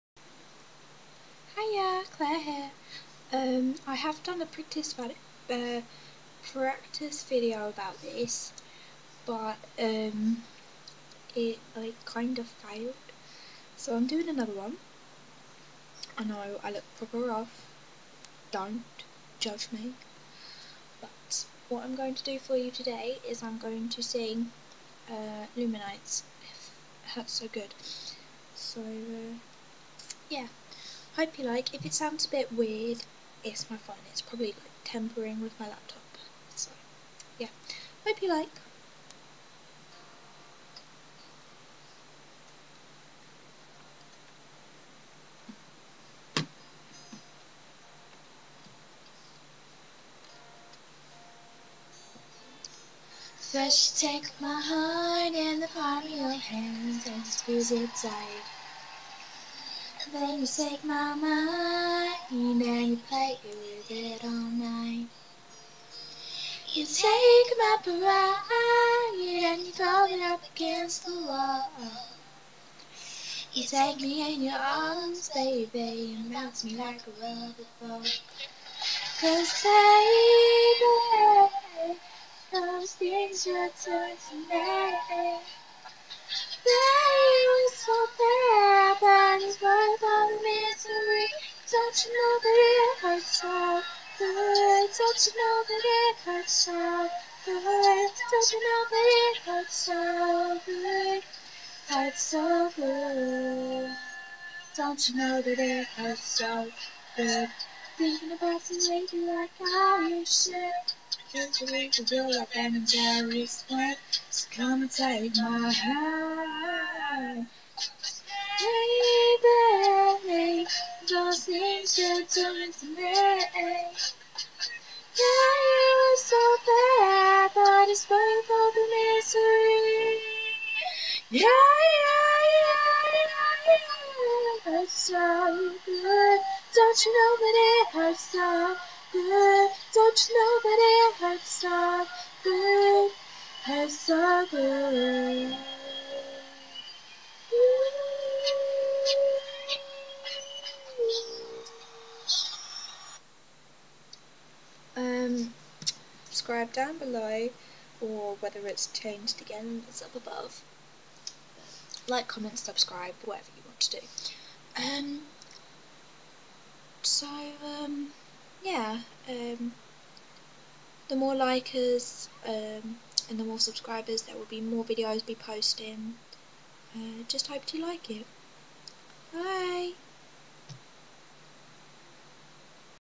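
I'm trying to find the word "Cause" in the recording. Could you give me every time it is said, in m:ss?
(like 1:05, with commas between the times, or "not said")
1:19, 1:51.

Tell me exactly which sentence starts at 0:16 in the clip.
I know I look proper rough.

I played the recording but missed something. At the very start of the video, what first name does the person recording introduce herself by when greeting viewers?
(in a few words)
Claire.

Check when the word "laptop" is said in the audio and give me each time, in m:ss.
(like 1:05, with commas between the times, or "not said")
0:35.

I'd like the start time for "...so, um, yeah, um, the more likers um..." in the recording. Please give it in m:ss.
2:47.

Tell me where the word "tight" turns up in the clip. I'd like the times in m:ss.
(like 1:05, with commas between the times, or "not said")
0:58.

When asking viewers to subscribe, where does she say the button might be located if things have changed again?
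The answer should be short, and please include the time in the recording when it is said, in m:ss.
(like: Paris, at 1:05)
Up above, at 2:40.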